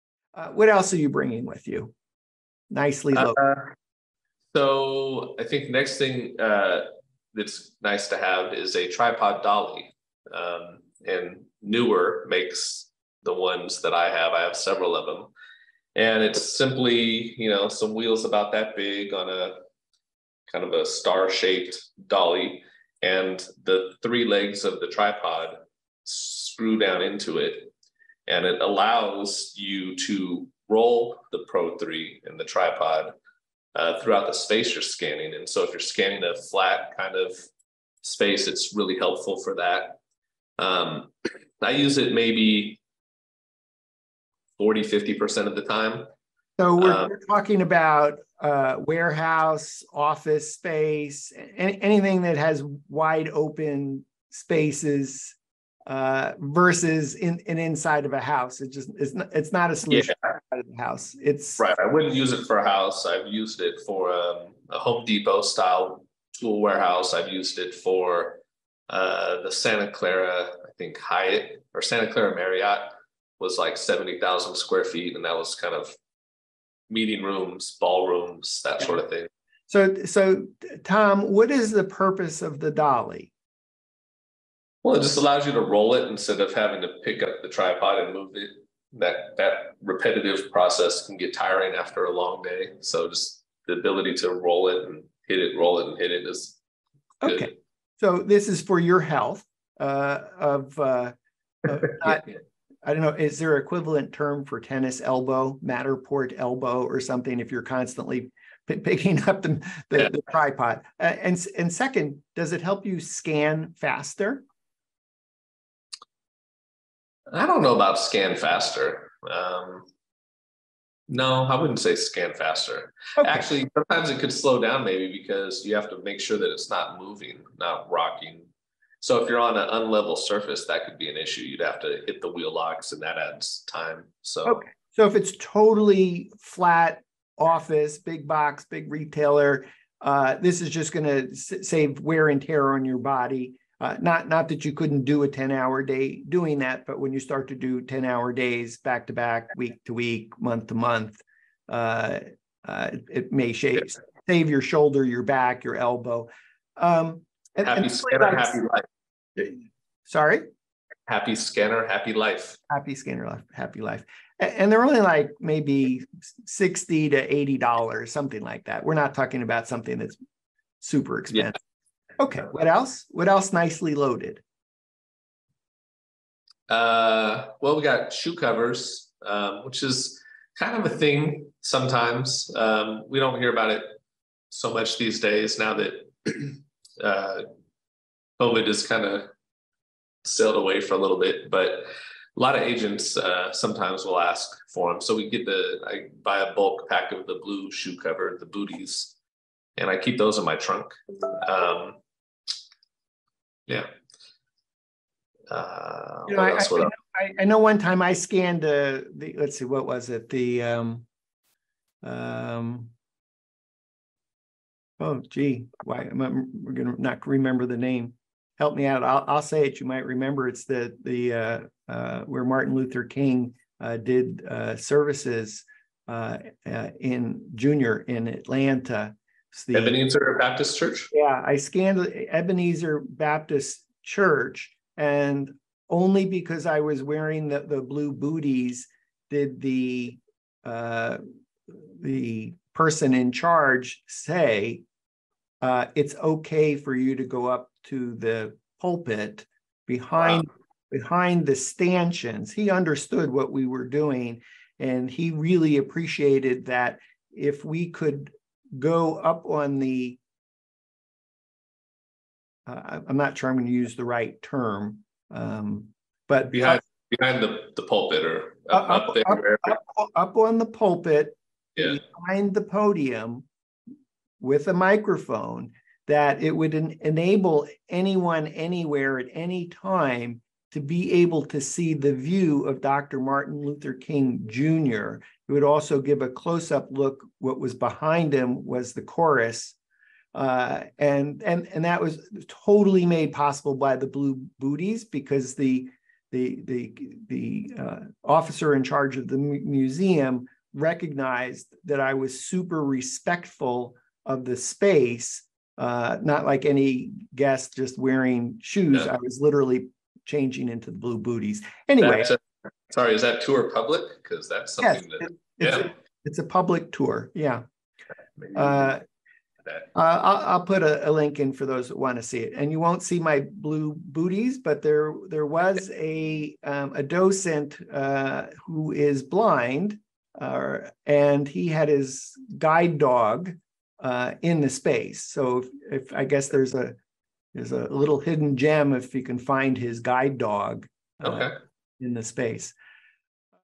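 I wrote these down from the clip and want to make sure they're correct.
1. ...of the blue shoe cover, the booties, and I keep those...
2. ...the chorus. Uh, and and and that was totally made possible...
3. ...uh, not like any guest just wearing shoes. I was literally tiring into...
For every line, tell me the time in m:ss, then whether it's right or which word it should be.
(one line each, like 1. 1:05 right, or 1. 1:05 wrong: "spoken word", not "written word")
1. 3:17 right
2. 4:48 right
3. 5:05 wrong: "changing", not "tiring".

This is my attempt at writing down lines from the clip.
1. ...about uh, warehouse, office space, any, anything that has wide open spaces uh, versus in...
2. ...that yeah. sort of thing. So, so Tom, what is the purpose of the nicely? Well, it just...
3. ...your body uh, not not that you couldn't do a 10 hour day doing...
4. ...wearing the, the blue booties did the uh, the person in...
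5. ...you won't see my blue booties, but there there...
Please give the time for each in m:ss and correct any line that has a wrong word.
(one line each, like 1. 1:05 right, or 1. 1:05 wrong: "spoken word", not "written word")
1. 0:47 right
2. 1:18 wrong: "dolly", not "nicely"
3. 2:22 right
4. 3:57 right
5. 5:22 right.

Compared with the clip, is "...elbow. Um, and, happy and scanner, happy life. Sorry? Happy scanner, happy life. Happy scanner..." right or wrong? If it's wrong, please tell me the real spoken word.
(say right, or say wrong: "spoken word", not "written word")
right.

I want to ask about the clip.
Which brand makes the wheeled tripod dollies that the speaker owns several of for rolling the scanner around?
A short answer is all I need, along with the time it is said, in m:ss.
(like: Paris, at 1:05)
Neewer, at 0:11.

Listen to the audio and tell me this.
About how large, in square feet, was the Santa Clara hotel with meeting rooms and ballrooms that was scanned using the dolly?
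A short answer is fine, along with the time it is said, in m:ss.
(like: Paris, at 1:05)
70,000 square feet, at 1:13.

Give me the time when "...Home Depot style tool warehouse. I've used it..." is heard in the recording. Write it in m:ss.
1:04.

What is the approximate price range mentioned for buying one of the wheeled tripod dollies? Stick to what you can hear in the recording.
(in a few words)
$60 to $80.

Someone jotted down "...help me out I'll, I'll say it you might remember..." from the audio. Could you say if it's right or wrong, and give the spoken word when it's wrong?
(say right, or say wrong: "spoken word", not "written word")
right.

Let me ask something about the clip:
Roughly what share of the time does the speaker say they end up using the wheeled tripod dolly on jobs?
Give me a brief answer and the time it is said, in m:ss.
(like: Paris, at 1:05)
40 to 50%, at 0:44.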